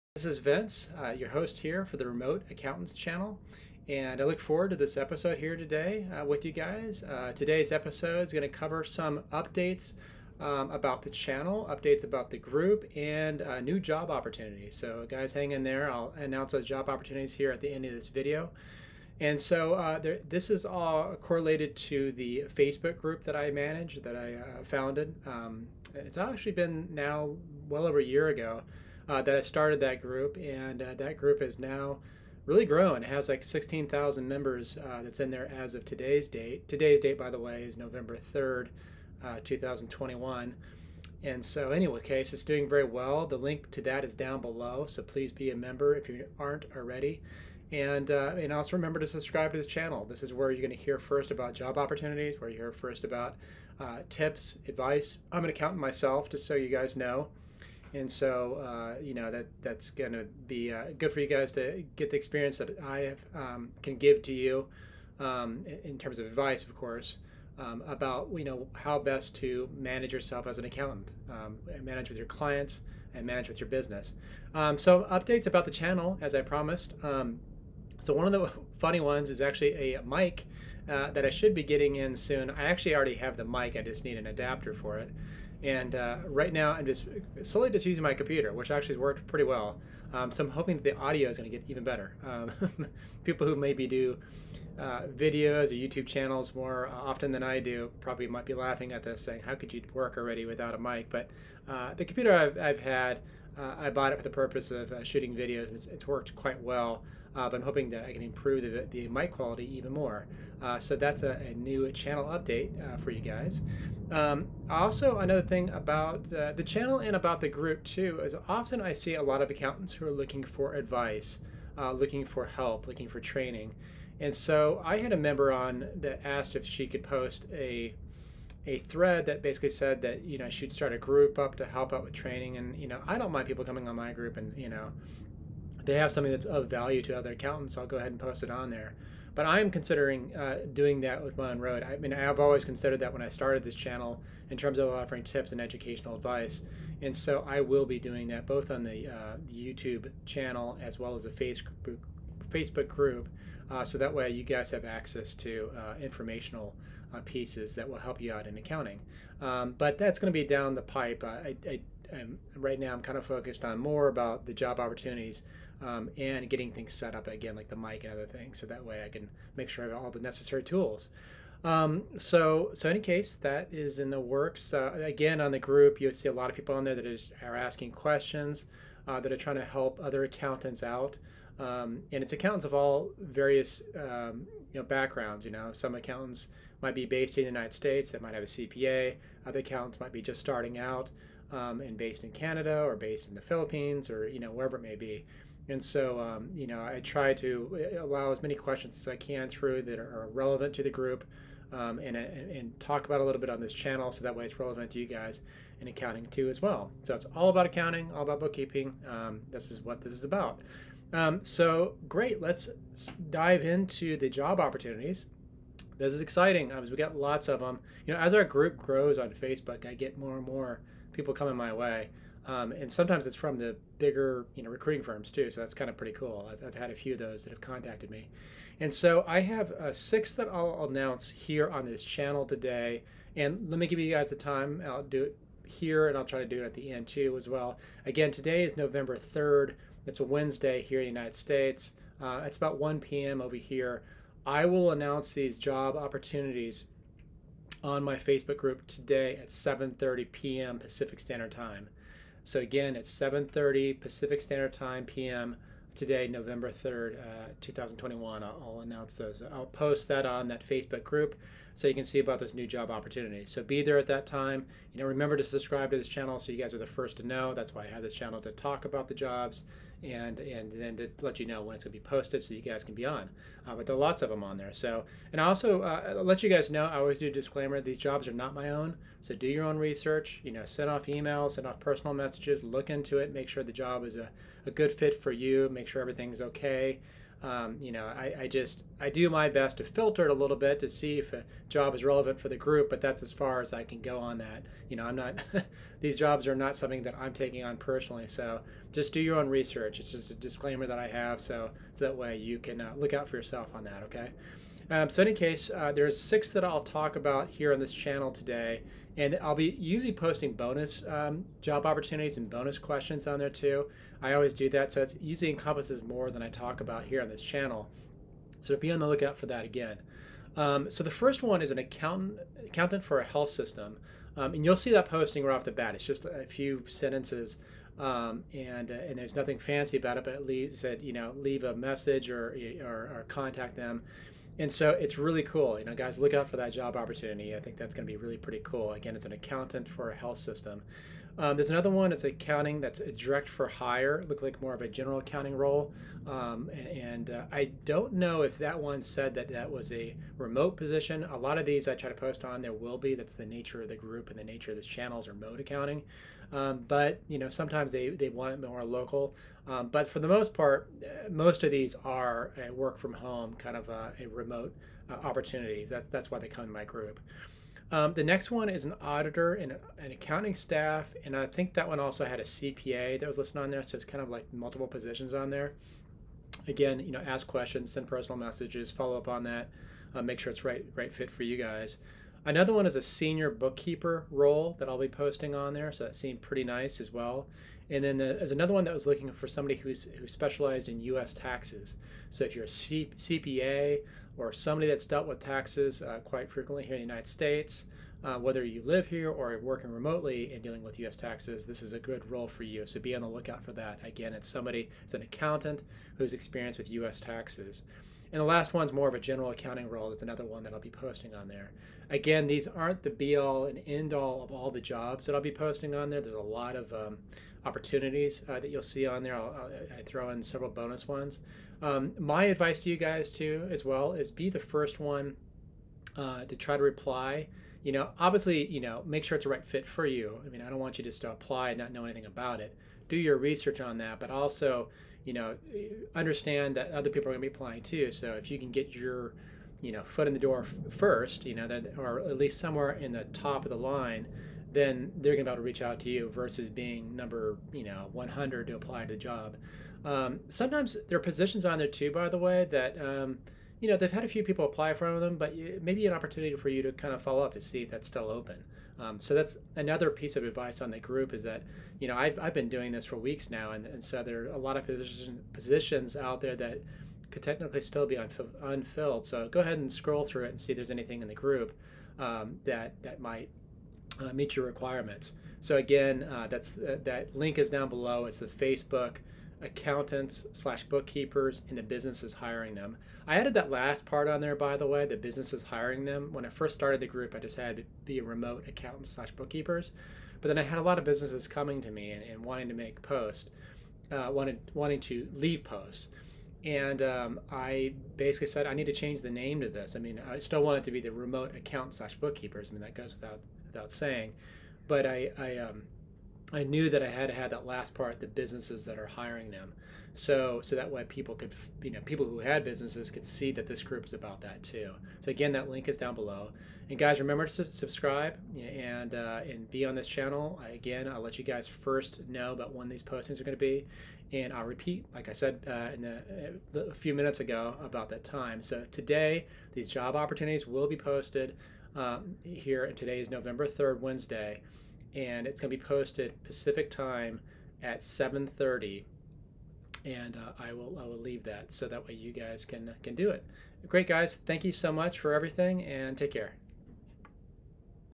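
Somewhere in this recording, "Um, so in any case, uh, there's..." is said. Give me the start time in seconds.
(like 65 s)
304 s.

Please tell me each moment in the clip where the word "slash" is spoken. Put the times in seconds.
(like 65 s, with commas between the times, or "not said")
480 s, 489 s, 501 s.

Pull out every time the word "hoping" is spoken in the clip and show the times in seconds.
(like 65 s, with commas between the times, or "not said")
90 s, 107 s.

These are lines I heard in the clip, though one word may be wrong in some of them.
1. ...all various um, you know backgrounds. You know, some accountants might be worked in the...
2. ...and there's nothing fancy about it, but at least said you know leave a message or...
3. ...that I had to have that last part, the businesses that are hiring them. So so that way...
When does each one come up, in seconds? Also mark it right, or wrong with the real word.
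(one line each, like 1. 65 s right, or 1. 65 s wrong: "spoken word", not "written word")
1. 182 s wrong: "based", not "worked"
2. 329 s right
3. 506 s right.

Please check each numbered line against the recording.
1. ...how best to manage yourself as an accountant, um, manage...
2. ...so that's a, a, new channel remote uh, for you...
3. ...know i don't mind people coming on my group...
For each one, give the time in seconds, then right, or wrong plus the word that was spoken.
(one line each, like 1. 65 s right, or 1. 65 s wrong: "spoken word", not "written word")
1. 68 s right
2. 110 s wrong: "update", not "remote"
3. 132 s right.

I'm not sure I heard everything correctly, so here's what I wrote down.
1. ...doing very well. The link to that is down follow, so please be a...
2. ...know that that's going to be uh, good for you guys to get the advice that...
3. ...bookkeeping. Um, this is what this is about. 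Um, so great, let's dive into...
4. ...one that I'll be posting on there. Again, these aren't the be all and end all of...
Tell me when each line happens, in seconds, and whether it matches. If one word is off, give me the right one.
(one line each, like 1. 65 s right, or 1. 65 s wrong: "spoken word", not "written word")
1. 42 s wrong: "below", not "follow"
2. 59 s wrong: "experience", not "advice"
3. 208 s right
4. 410 s right.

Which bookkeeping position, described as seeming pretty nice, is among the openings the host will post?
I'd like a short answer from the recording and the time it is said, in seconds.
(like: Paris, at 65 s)
senior bookkeeper, at 383 s.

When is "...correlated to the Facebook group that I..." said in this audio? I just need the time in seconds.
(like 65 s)
21 s.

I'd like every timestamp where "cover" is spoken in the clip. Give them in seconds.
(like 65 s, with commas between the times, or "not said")
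8 s.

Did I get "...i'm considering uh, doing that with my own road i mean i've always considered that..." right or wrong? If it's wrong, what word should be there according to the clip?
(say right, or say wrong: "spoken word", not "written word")
right.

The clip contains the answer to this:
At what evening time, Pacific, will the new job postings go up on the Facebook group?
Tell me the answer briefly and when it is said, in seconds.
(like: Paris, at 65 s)
7:30 p.m., at 249 s.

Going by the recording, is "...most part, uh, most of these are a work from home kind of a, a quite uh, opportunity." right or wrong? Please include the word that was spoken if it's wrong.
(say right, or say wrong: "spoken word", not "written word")
wrong: "remote", not "quite".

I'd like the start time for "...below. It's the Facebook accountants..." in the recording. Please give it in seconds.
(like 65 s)
477 s.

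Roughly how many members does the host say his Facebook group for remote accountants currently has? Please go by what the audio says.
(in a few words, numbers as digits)
16,000.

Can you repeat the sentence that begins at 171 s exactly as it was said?
Um, so, so in any case, that is in the works.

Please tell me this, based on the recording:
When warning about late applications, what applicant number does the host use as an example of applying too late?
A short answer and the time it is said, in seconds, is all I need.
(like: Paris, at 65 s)
100, at 448 s.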